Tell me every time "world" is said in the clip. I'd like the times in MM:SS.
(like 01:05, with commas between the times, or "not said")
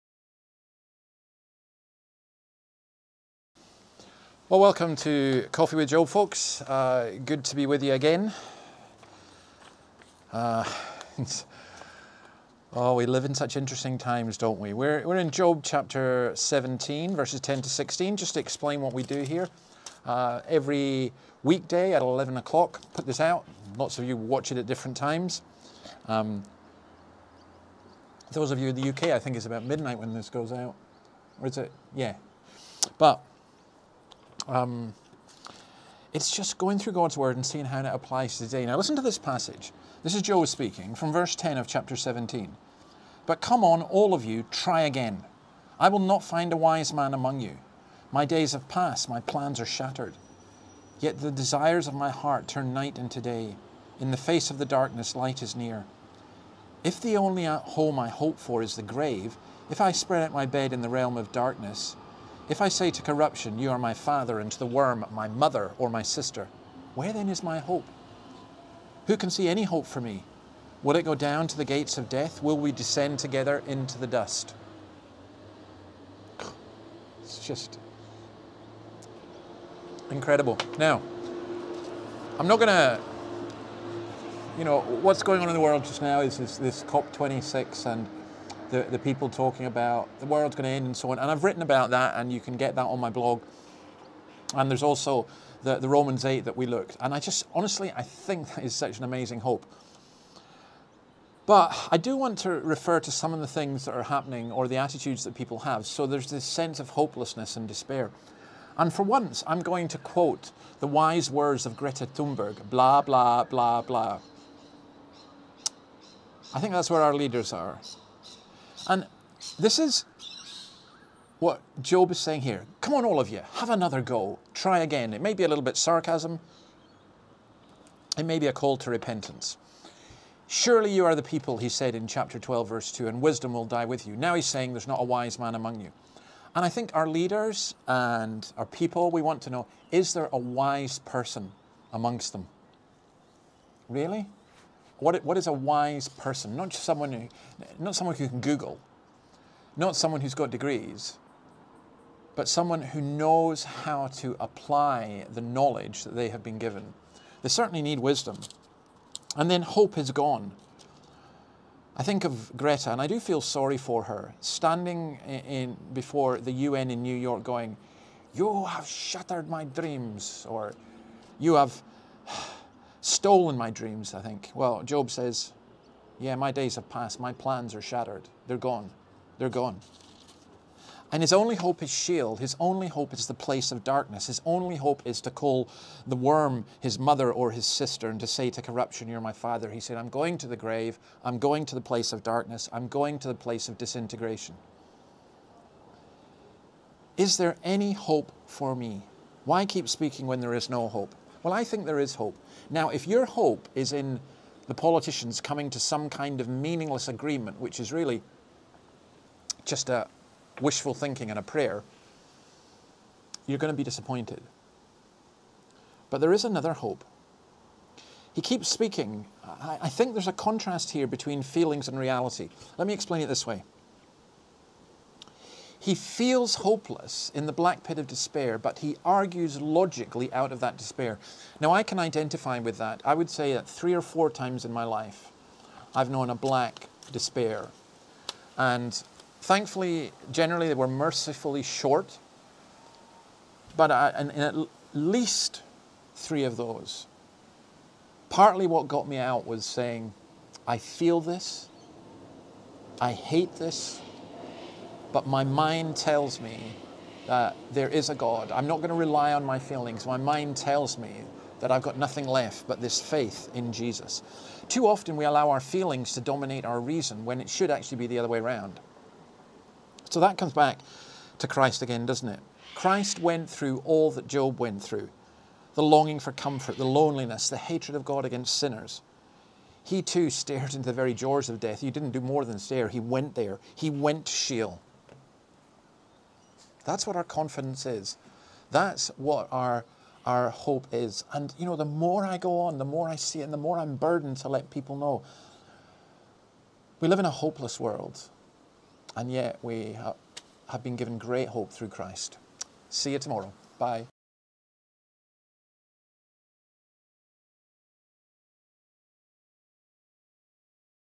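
01:25, 01:30, 04:57.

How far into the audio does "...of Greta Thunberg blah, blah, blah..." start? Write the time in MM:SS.
01:51.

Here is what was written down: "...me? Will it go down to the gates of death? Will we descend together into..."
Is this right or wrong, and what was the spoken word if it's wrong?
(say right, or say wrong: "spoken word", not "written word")
right.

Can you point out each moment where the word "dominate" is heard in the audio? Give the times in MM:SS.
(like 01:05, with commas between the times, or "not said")
04:26.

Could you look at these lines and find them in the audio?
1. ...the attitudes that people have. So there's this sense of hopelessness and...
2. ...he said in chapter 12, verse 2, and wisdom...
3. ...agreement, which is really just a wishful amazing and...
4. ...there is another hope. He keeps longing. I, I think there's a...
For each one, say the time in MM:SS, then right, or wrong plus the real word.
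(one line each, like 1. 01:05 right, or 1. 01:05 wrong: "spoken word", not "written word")
1. 01:44 right
2. 02:11 right
3. 03:27 wrong: "thinking", not "amazing"
4. 03:36 wrong: "speaking", not "longing".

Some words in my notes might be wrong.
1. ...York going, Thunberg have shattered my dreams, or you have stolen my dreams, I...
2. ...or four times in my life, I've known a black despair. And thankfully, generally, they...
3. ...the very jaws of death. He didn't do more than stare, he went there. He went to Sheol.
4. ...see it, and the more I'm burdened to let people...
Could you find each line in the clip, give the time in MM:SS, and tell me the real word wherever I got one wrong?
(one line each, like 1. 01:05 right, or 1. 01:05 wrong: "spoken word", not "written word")
1. 02:47 wrong: "You", not "Thunberg"
2. 03:53 right
3. 04:40 right
4. 04:53 right.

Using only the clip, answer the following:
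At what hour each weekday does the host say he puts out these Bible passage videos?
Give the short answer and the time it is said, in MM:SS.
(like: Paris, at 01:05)
11 o'clock, at 00:22.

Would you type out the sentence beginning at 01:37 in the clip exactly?
And I just, honestly, I think that is such an amazing hope.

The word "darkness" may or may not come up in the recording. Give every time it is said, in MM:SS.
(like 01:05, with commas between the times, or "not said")
00:54, 01:01, 03:03, 03:12.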